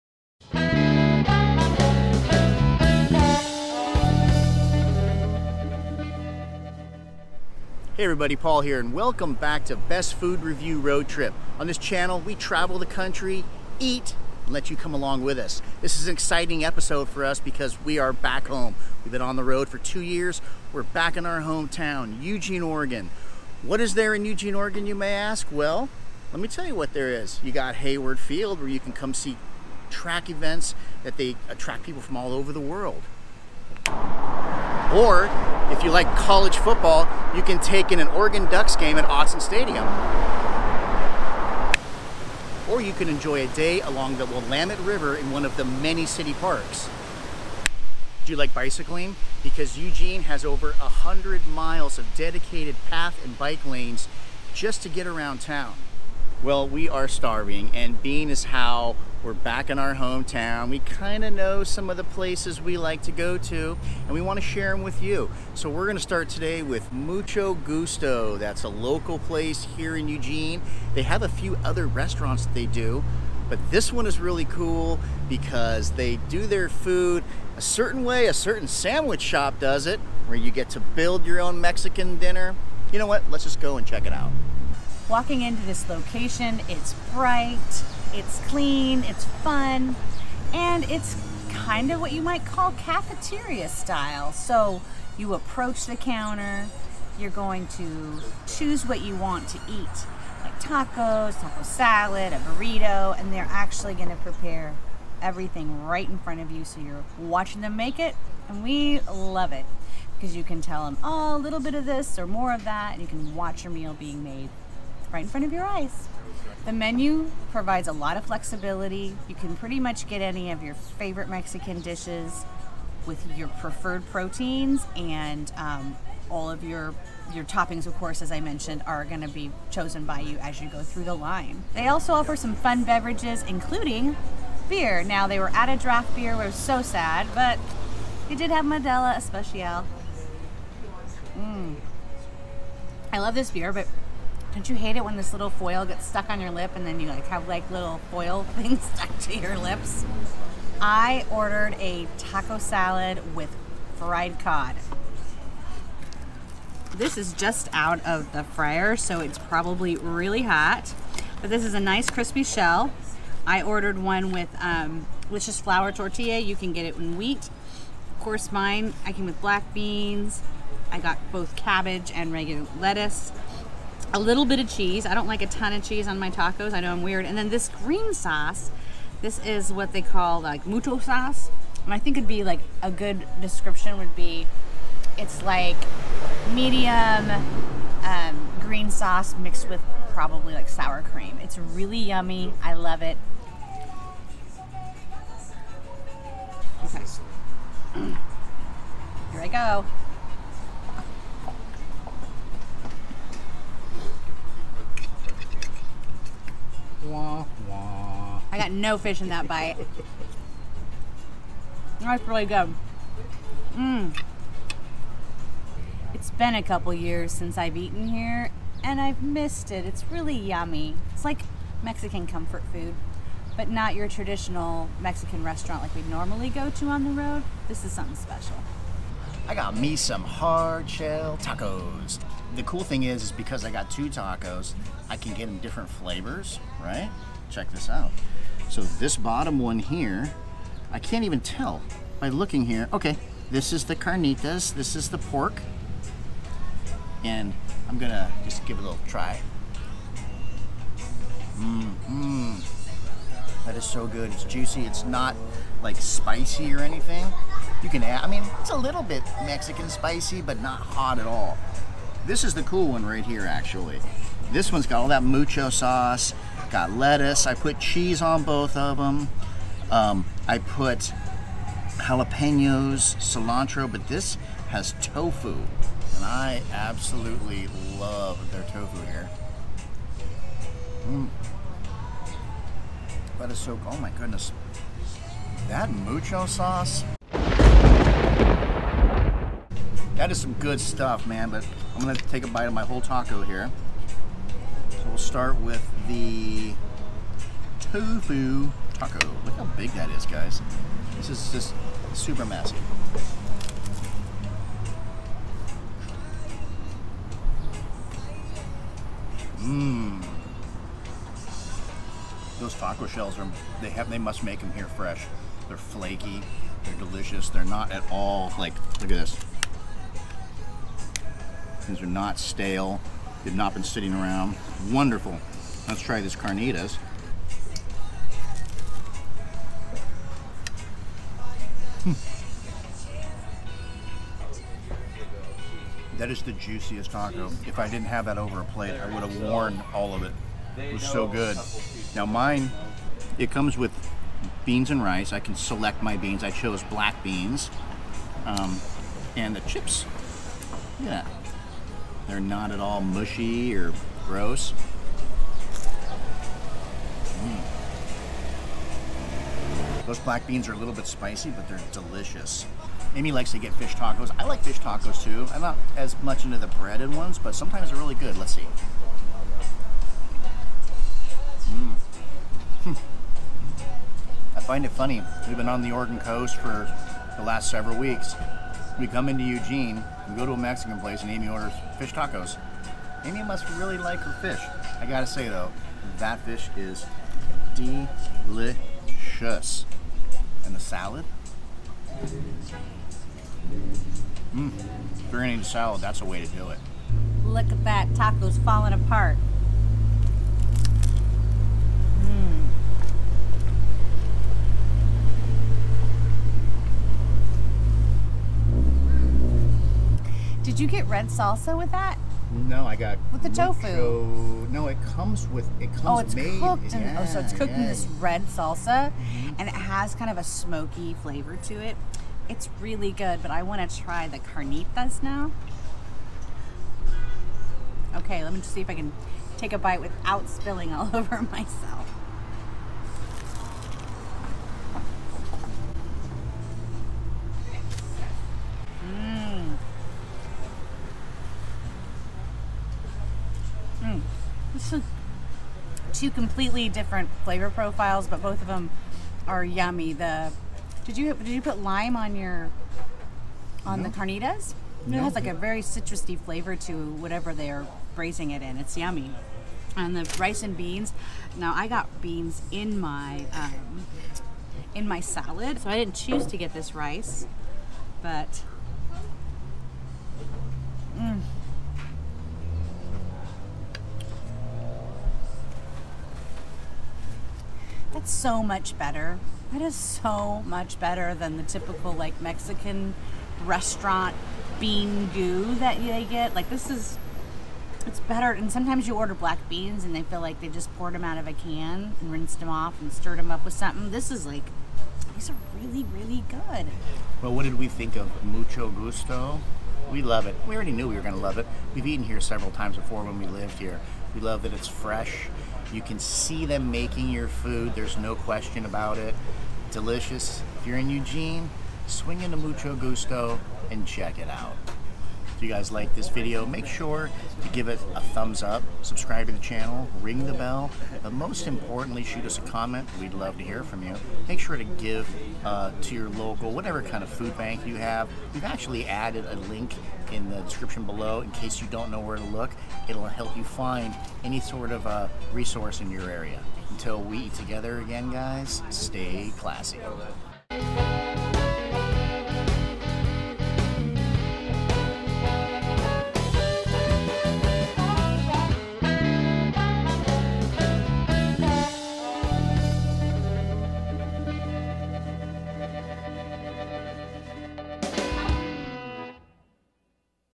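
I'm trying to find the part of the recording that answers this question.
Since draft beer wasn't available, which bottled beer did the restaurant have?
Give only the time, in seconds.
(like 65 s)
138 s.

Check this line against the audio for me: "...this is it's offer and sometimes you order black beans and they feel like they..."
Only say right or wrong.
wrong.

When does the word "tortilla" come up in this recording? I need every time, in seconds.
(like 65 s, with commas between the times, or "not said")
165 s.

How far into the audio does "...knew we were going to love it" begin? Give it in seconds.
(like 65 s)
500 s.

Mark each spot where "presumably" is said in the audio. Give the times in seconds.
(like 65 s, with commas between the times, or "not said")
not said.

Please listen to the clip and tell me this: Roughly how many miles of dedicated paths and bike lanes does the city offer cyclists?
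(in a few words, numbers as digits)
100.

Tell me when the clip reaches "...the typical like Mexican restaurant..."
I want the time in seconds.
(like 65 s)
481 s.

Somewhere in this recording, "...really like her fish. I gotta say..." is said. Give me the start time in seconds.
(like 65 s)
383 s.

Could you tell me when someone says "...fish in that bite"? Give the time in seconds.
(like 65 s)
208 s.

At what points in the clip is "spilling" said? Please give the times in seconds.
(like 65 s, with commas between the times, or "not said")
430 s.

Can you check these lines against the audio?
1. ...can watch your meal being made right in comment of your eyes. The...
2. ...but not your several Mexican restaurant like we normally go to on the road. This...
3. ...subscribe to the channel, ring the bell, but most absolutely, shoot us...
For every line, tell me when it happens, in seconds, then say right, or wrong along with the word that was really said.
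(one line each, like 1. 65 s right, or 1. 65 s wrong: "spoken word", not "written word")
1. 113 s wrong: "front", not "comment"
2. 223 s wrong: "traditional", not "several"
3. 519 s wrong: "importantly", not "absolutely".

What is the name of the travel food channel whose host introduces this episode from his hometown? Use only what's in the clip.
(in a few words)
Best Food Review Road Trip.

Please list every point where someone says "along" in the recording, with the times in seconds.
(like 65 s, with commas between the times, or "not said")
14 s, 43 s.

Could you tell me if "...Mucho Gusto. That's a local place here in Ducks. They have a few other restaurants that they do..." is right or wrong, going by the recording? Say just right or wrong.
wrong.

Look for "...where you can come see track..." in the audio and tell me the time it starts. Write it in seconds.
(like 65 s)
28 s.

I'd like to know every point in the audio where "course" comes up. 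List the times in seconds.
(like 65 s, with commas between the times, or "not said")
127 s, 168 s.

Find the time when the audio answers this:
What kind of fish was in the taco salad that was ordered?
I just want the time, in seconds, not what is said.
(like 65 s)
154 s.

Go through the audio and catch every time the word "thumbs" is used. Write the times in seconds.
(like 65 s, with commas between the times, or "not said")
518 s.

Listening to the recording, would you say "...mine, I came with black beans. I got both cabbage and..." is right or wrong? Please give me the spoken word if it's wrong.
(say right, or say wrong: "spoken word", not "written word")
right.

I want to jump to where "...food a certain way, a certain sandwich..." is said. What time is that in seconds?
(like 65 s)
76 s.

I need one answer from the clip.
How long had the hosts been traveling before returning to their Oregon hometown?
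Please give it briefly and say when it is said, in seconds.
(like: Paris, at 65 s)
2 years, at 19 s.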